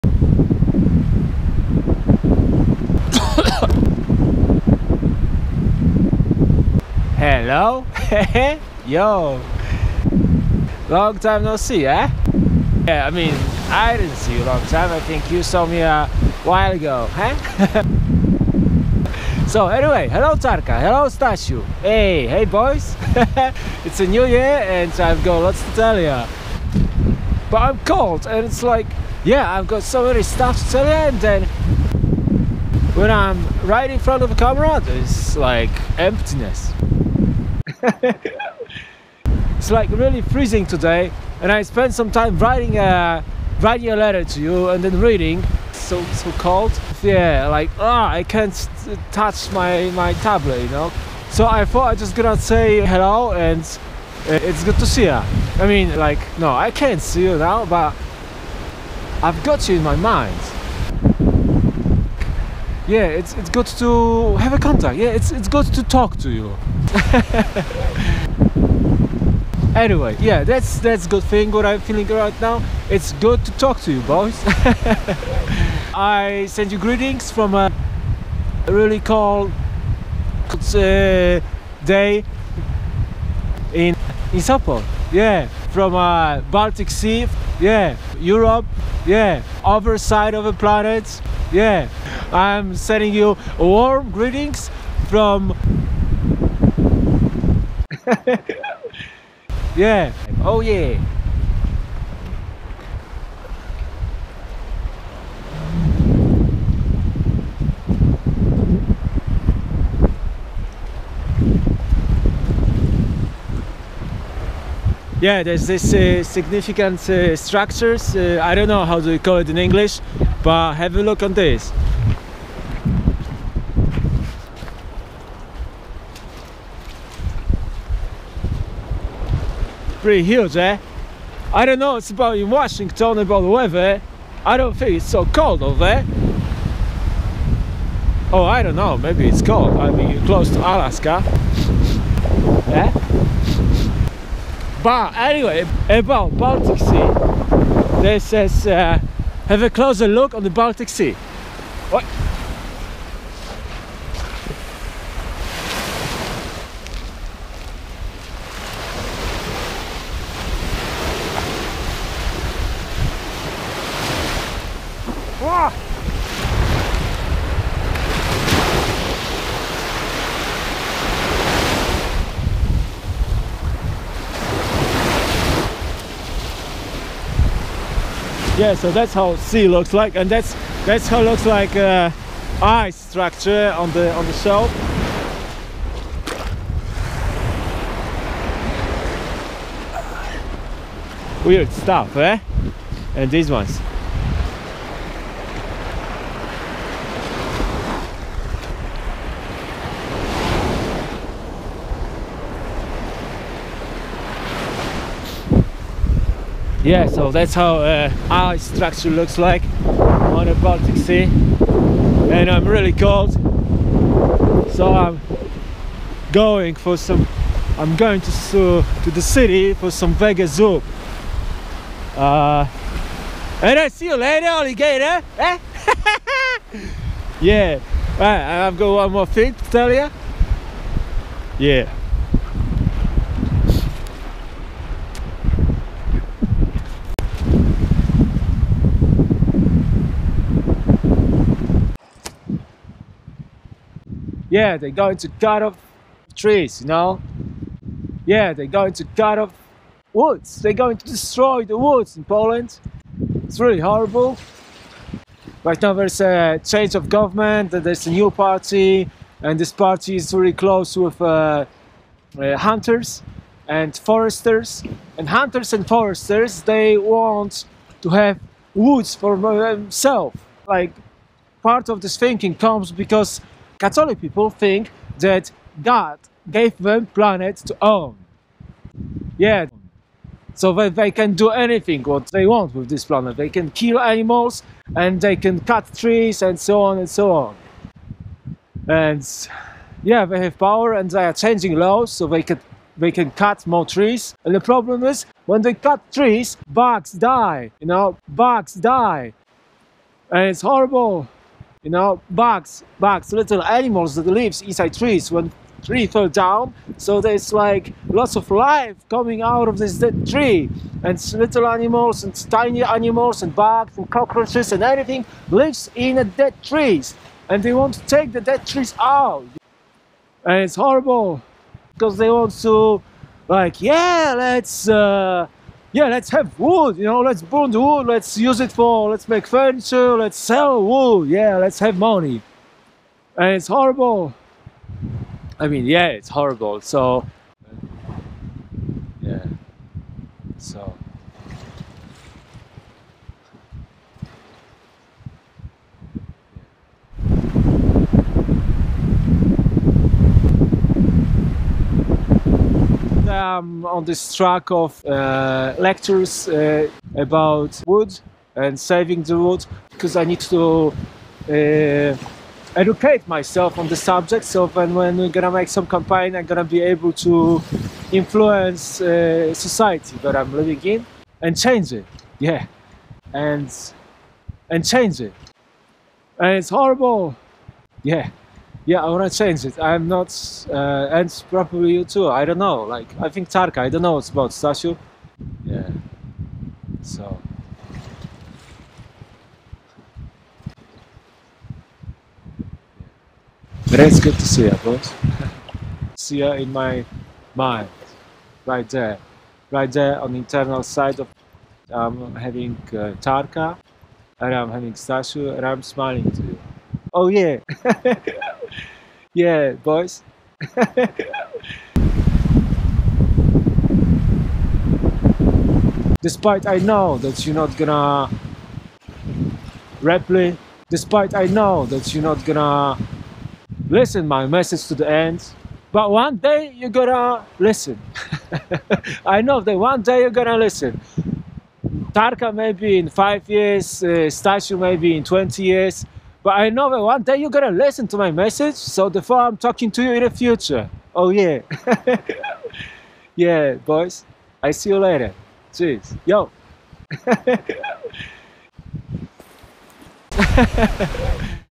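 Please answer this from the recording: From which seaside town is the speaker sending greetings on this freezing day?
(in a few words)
Sopot.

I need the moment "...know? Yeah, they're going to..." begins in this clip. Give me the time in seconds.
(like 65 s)
246 s.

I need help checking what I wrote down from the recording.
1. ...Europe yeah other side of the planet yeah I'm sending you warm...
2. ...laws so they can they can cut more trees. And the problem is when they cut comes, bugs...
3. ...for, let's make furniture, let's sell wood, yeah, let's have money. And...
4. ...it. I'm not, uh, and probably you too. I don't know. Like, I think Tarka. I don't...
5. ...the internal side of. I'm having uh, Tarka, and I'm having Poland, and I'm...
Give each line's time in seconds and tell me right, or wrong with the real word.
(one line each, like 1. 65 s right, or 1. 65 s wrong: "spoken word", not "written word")
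1. 88 s right
2. 291 s wrong: "trees", not "comes"
3. 328 s right
4. 379 s right
5. 400 s wrong: "Stasiu", not "Poland".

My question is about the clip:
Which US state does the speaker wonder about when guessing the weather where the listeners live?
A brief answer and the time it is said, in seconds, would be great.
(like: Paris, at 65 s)
Washington, at 132 s.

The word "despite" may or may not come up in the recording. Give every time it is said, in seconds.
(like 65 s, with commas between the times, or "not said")
416 s, 420 s.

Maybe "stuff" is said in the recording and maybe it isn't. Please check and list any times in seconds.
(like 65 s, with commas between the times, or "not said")
30 s, 191 s.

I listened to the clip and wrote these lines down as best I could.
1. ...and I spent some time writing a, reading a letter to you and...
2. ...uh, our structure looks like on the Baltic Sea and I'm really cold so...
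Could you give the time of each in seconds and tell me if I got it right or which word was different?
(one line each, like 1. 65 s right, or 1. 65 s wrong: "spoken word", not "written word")
1. 41 s wrong: "writing", not "reading"
2. 207 s right.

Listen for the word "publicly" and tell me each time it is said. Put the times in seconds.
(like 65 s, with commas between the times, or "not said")
not said.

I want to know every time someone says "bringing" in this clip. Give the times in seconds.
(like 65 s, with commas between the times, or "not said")
not said.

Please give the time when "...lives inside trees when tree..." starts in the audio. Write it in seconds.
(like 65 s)
304 s.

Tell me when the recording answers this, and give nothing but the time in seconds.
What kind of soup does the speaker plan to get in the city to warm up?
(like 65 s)
220 s.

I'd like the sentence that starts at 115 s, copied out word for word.
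Yeah, there's this uh, significant uh, structures.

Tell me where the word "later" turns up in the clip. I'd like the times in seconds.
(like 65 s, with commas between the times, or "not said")
224 s, 444 s.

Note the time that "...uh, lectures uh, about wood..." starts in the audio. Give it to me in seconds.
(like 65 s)
355 s.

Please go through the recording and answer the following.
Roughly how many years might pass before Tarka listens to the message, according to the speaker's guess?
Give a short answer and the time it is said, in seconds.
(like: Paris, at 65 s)
5, at 433 s.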